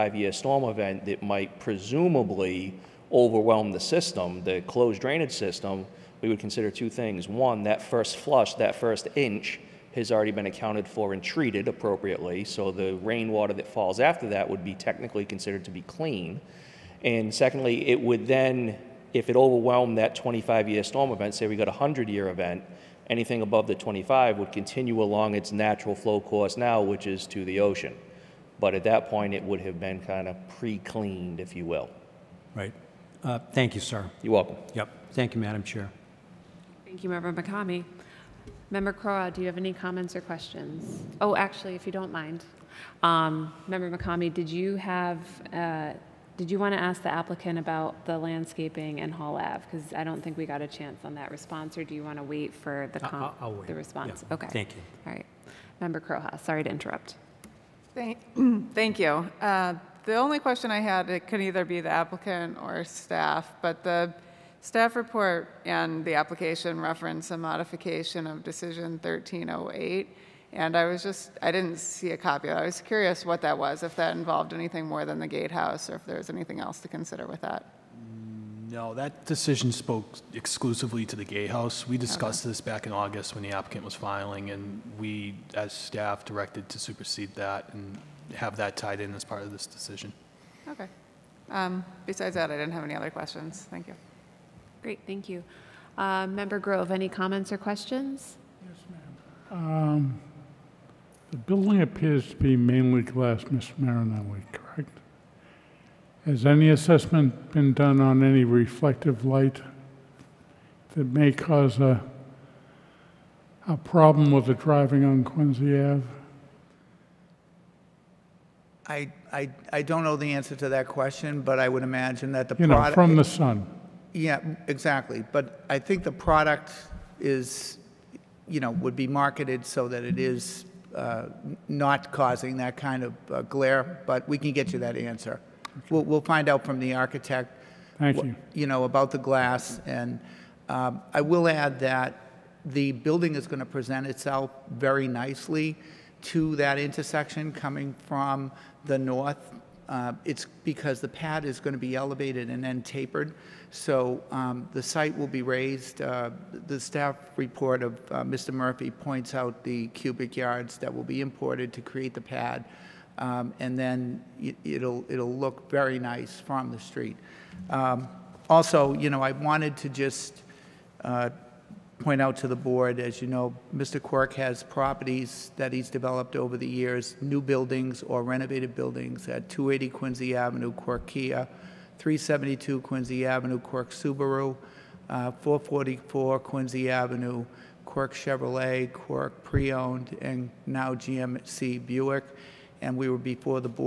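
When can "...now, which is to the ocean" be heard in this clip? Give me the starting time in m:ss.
0:26.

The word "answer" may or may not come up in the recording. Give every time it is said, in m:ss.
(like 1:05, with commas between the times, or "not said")
2:00, 2:14.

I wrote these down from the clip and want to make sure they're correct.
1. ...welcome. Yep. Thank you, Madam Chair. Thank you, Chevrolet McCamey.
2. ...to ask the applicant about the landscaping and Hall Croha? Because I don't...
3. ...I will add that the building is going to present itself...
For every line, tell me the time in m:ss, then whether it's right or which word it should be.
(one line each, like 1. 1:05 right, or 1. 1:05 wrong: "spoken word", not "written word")
1. 0:34 wrong: "Reverend", not "Chevrolet"
2. 0:46 wrong: "Ave", not "Croha"
3. 2:21 right.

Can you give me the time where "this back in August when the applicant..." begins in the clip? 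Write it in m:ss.
1:22.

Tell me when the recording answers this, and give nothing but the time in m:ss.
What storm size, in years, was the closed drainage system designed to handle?
0:20.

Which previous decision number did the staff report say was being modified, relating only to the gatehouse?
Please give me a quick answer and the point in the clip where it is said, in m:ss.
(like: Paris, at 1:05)
1308, at 1:09.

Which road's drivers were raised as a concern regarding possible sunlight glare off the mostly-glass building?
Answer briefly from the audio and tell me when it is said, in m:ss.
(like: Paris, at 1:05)
Quincy Ave, at 1:55.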